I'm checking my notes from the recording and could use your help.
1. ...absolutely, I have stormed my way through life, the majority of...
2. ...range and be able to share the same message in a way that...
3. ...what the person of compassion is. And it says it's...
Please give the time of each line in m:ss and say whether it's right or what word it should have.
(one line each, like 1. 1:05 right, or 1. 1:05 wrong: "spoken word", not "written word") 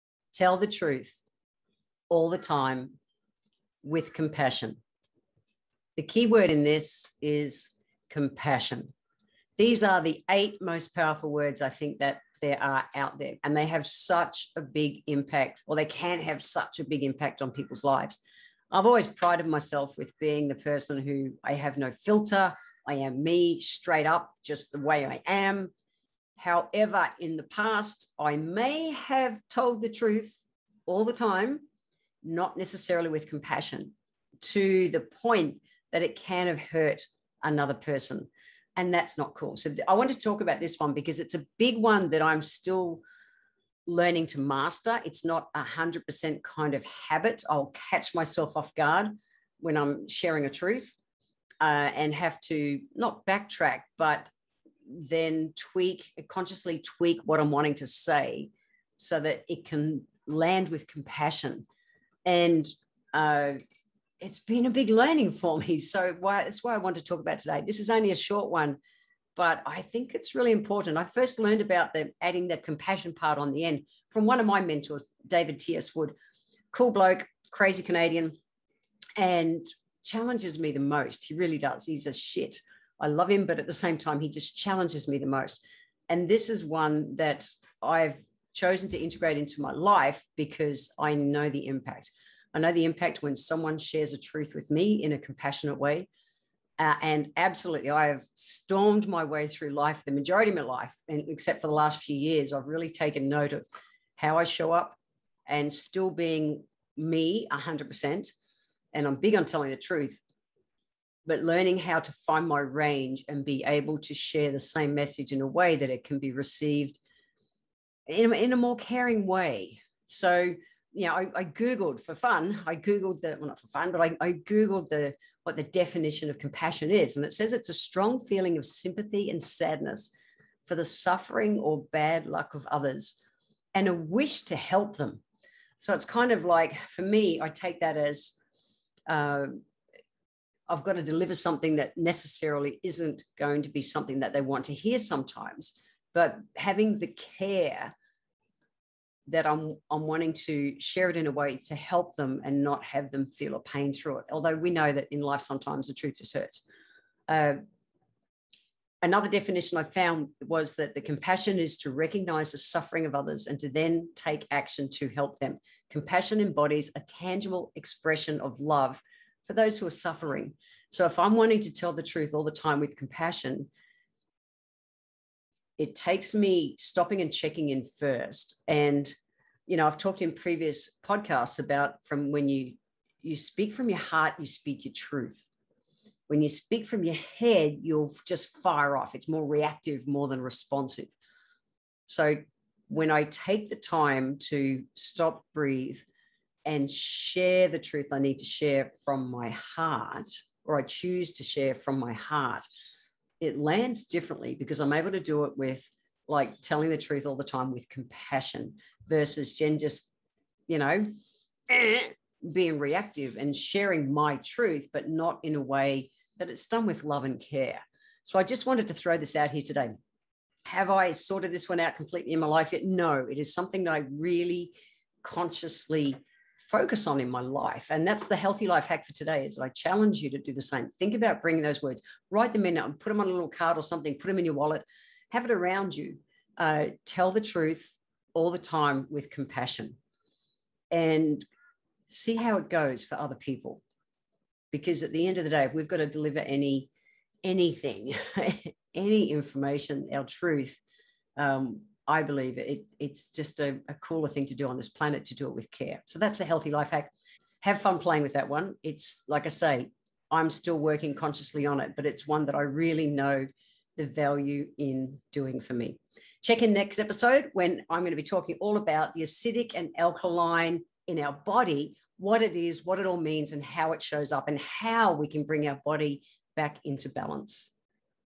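1. 1:37 right
2. 1:52 right
3. 2:05 wrong: "definition", not "person".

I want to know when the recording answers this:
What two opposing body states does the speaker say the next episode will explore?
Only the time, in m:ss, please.
4:29.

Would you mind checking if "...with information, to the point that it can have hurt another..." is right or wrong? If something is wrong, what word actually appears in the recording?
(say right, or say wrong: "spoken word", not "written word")
wrong: "compassion", not "information".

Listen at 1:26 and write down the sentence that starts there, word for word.
And this is one that I've chosen to integrate into my life because I know the impact.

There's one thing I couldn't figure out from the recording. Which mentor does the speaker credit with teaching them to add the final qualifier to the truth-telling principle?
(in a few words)
David T.S. Wood.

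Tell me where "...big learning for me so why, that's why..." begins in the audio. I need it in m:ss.
1:04.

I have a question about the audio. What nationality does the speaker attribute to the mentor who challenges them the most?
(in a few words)
Canadian.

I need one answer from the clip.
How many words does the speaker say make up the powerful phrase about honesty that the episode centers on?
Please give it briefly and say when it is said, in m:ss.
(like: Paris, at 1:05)
8, at 0:10.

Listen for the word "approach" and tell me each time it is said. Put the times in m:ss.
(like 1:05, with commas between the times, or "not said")
not said.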